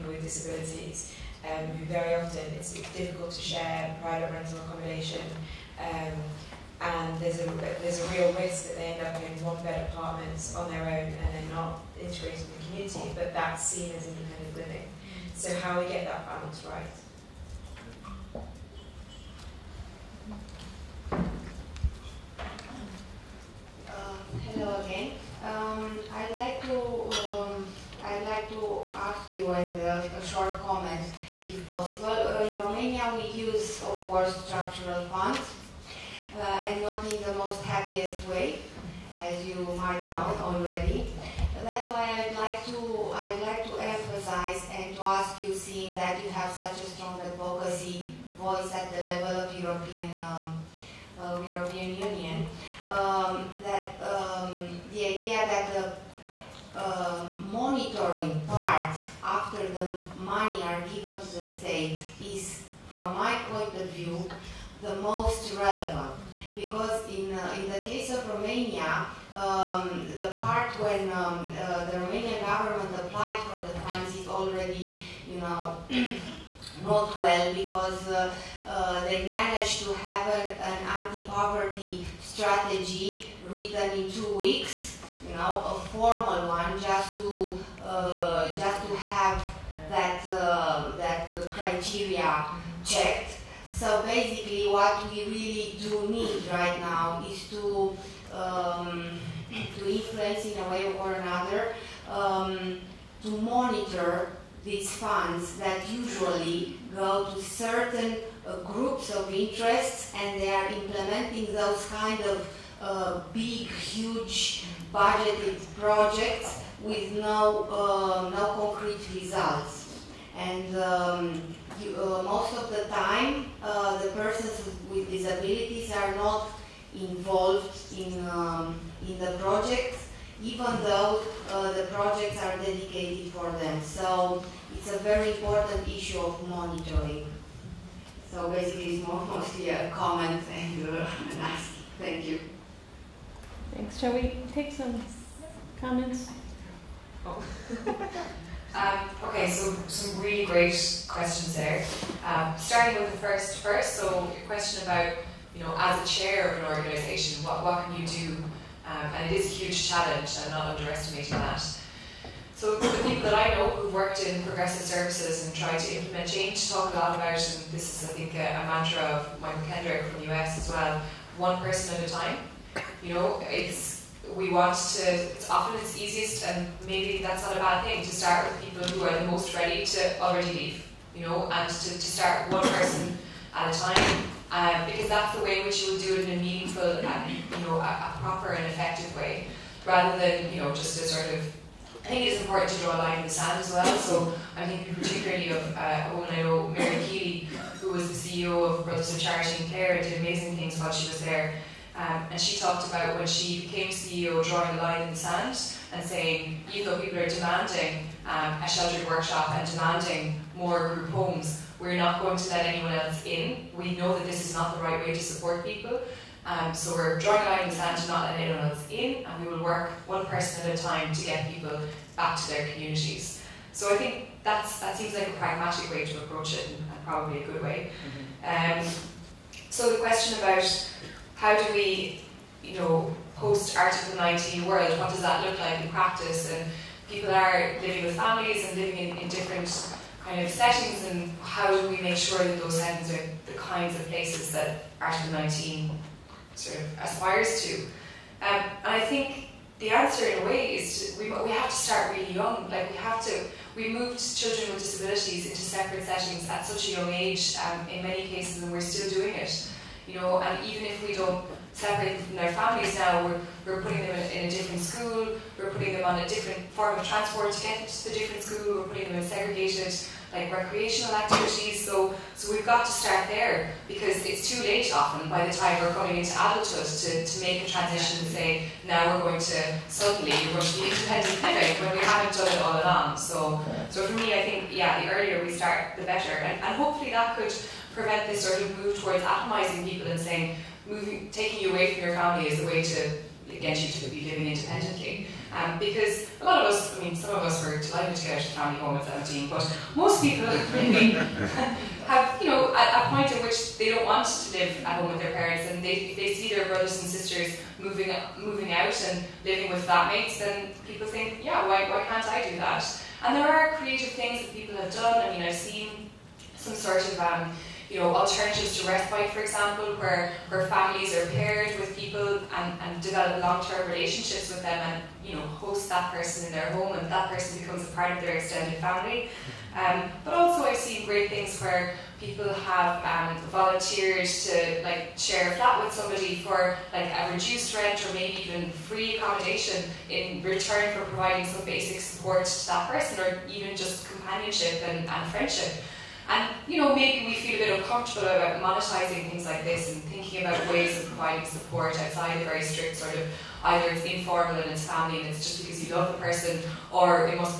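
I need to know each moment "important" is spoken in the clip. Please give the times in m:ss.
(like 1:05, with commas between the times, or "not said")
2:15, 3:12.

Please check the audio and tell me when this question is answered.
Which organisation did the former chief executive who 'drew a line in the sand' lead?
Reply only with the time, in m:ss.
3:18.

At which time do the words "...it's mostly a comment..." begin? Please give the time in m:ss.
2:18.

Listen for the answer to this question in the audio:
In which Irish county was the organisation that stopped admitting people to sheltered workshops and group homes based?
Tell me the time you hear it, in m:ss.
3:19.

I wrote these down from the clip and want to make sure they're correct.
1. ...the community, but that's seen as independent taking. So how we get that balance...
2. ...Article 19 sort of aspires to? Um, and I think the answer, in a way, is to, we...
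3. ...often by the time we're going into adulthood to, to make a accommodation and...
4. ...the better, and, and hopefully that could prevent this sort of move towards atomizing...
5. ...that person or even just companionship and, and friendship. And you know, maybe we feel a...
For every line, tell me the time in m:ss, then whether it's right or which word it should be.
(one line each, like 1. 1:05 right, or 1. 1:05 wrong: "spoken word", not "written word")
1. 0:12 wrong: "living", not "taking"
2. 4:04 right
3. 4:34 wrong: "transition", not "accommodation"
4. 4:45 right
5. 5:42 right.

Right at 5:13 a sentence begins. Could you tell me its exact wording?
And there are creative things that people have done.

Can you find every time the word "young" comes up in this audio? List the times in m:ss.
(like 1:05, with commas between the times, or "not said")
4:12, 4:16.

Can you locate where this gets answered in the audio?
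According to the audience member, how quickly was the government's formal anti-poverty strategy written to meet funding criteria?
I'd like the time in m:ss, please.
1:24.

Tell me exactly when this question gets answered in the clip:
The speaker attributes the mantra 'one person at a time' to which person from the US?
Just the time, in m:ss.
2:49.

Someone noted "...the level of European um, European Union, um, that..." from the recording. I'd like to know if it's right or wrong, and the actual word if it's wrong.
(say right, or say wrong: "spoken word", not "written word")
right.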